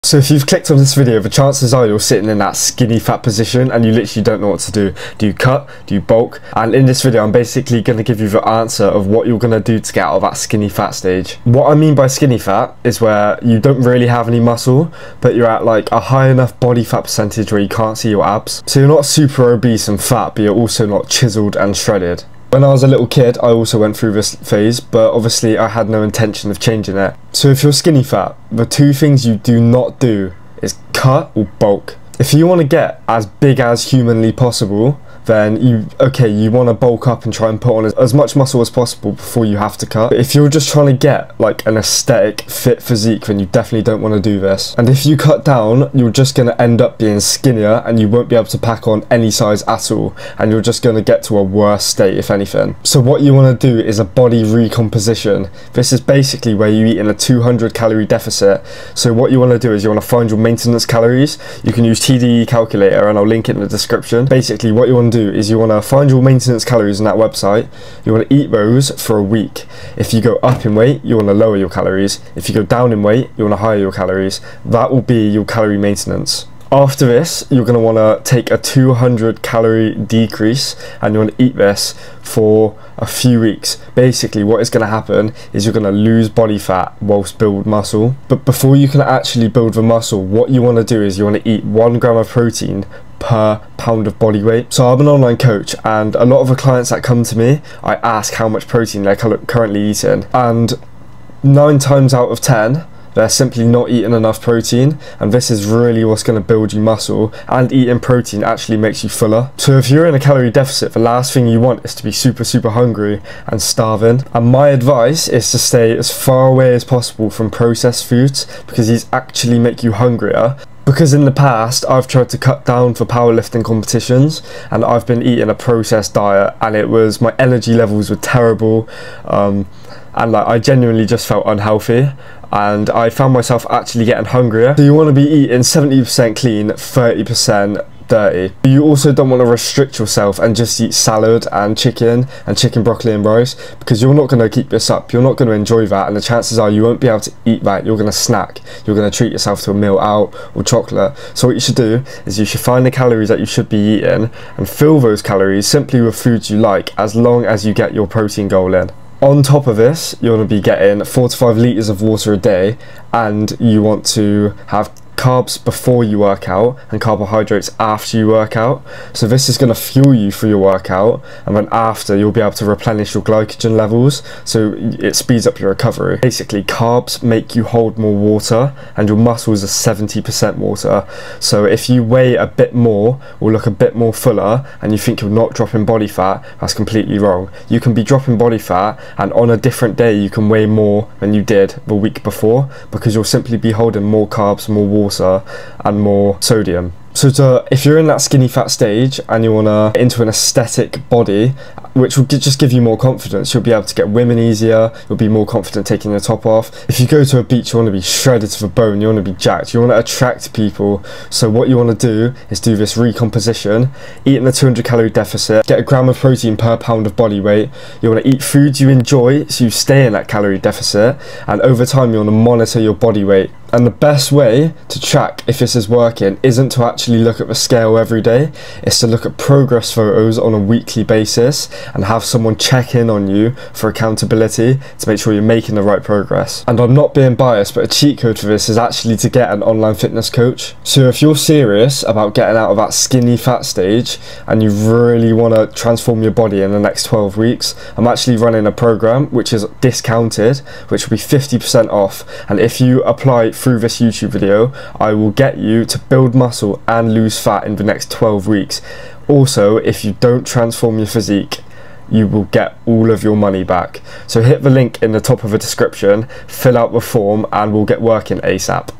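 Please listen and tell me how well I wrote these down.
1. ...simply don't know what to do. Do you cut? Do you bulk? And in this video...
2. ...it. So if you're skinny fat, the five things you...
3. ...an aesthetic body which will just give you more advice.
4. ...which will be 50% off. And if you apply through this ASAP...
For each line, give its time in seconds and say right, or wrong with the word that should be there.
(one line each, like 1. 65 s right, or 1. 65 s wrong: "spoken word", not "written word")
1. 3 s wrong: "literally", not "simply"
2. 26 s wrong: "two", not "five"
3. 200 s wrong: "confidence", not "advice"
4. 250 s wrong: "YouTube", not "ASAP".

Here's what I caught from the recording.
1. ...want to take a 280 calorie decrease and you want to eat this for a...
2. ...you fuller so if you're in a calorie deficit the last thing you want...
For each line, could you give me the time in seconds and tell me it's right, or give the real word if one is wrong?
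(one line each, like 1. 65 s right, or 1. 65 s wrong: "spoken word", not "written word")
1. 77 s wrong: "200", not "280"
2. 109 s right.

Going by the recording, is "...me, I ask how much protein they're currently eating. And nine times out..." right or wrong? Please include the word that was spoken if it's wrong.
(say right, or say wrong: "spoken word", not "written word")
right.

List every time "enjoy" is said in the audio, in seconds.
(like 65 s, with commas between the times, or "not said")
145 s, 218 s.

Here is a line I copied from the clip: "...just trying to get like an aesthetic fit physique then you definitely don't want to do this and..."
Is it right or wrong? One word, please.
right.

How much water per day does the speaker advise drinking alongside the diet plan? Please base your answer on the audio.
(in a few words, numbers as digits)
4 to 5 litres.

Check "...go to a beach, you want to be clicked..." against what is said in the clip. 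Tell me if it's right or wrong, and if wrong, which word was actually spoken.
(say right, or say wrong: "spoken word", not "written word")
wrong: "shredded", not "clicked".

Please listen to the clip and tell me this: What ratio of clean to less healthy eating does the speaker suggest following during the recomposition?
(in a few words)
70% clean, 30% dirty.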